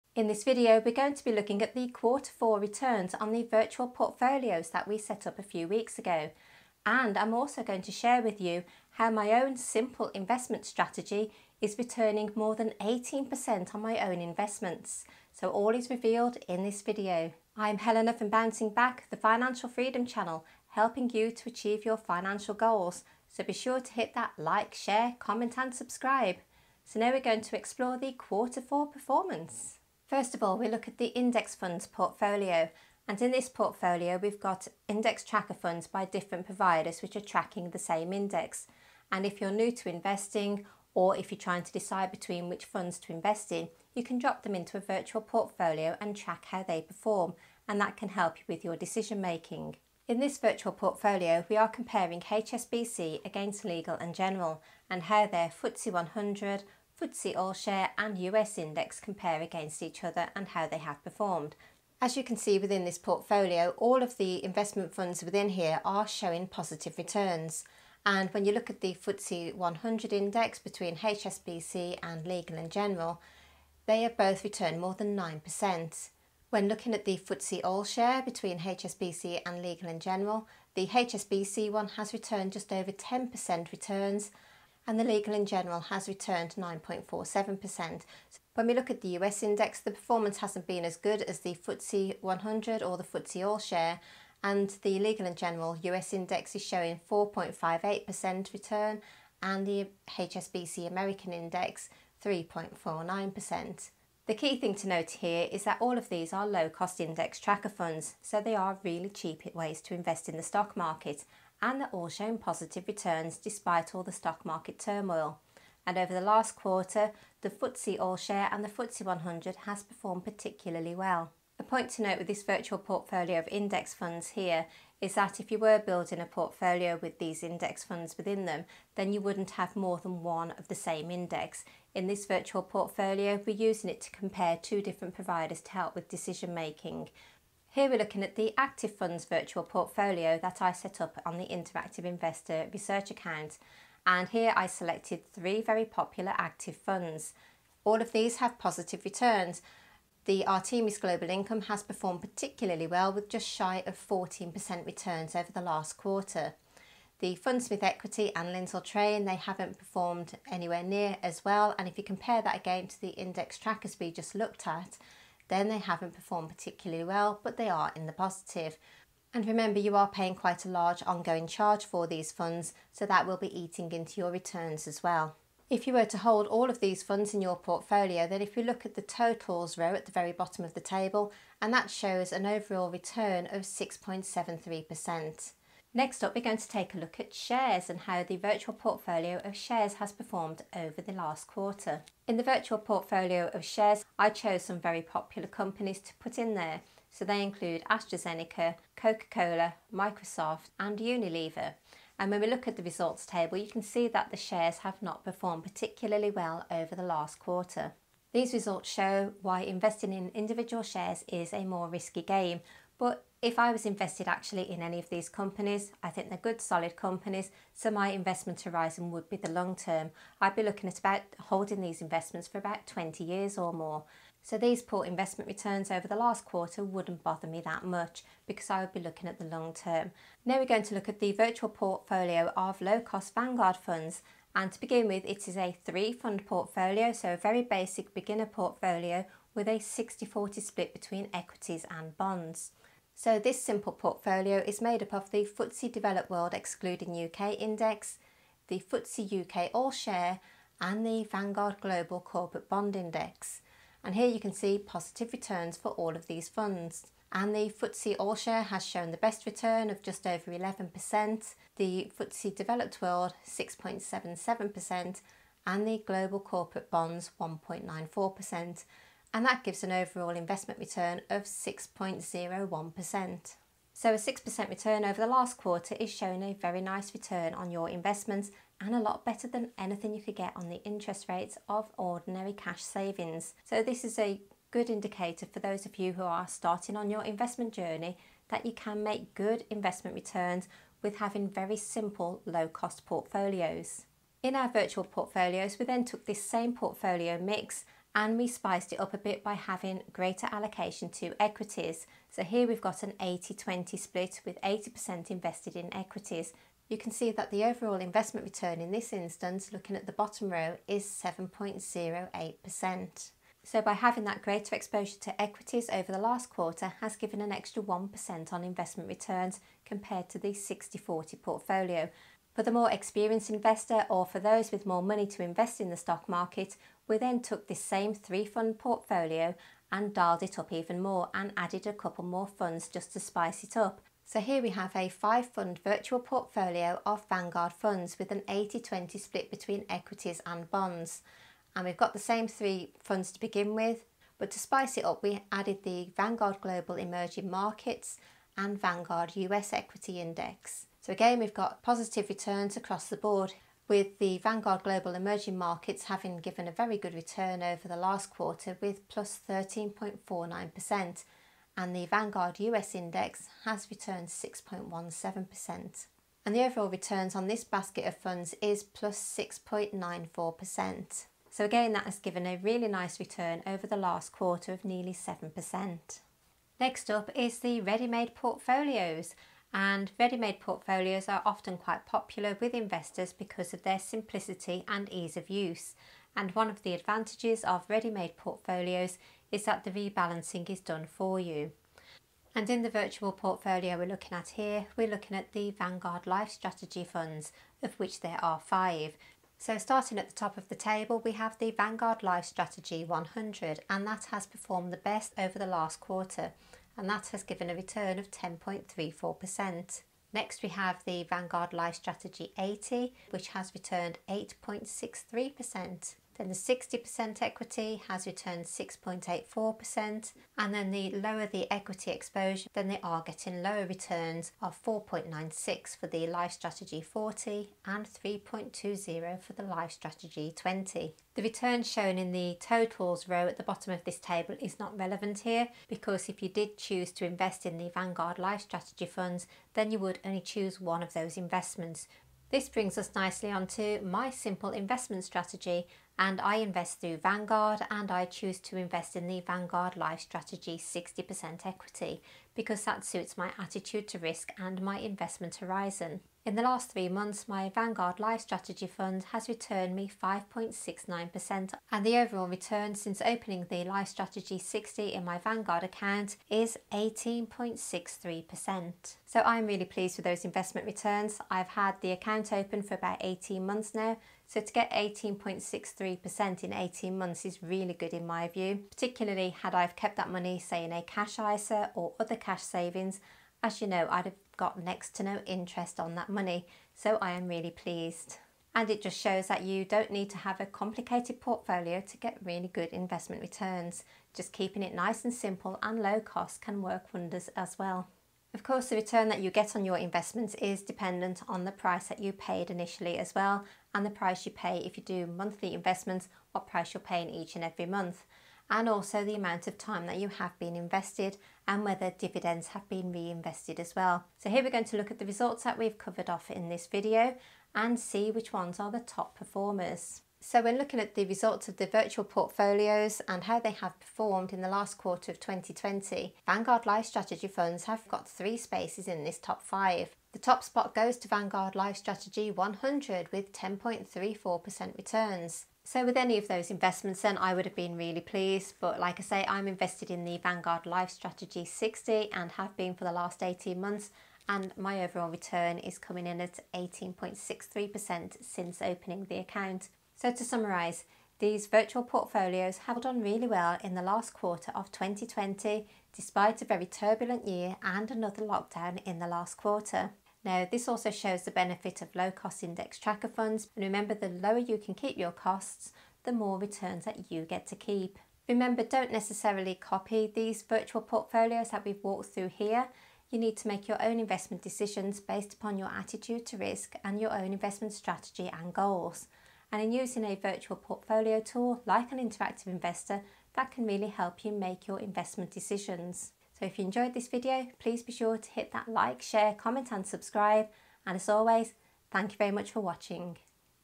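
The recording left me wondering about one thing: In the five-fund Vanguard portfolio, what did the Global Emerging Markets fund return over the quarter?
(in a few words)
13.49%.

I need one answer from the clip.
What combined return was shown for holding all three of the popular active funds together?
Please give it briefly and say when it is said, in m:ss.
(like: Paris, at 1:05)
6.73%, at 3:03.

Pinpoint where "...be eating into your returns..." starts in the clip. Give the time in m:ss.
2:53.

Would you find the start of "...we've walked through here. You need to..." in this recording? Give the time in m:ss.
9:31.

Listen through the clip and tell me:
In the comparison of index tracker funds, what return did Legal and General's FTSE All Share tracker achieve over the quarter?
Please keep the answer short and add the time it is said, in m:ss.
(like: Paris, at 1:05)
9.47%, at 1:26.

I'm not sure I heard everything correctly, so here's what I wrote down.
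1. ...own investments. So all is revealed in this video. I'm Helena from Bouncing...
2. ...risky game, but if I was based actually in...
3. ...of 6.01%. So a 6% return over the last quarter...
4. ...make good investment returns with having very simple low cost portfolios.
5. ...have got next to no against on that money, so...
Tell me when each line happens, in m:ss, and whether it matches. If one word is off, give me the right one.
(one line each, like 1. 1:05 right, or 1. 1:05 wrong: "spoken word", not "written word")
1. 0:14 right
2. 3:31 wrong: "invested", not "based"
3. 4:31 right
4. 4:49 right
5. 8:04 wrong: "interest", not "against".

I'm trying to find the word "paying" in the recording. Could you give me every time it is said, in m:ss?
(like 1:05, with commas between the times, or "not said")
2:50, 8:27.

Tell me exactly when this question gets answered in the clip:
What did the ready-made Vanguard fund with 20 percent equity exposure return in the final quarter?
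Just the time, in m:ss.
7:08.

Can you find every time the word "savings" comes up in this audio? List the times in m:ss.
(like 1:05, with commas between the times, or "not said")
4:42, 8:02.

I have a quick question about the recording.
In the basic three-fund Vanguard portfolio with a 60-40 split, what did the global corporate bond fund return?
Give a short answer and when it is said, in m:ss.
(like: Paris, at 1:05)
1.94%, at 4:27.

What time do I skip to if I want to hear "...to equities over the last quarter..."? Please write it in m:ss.
5:15.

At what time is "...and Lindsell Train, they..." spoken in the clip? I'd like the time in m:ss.
2:38.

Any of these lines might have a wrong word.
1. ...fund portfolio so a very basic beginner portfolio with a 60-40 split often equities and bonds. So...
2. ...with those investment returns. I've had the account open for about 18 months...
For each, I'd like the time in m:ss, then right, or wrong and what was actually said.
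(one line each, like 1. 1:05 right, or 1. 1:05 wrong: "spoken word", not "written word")
1. 3:56 wrong: "between", not "often"
2. 7:50 right.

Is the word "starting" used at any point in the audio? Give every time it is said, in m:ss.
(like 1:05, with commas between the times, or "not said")
4:46, 6:39.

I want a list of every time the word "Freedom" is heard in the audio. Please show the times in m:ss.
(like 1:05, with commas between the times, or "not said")
0:19.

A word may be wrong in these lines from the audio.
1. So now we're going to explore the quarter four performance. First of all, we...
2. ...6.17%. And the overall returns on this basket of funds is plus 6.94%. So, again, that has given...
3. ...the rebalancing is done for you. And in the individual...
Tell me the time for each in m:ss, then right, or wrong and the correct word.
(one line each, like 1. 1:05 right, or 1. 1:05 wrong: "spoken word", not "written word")
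1. 0:26 right
2. 6:04 right
3. 6:29 wrong: "virtual", not "individual".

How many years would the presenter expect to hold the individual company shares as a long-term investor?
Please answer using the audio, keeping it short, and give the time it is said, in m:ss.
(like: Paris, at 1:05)
20 years, at 3:42.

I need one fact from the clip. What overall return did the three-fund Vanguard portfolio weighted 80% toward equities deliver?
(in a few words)
7.08%.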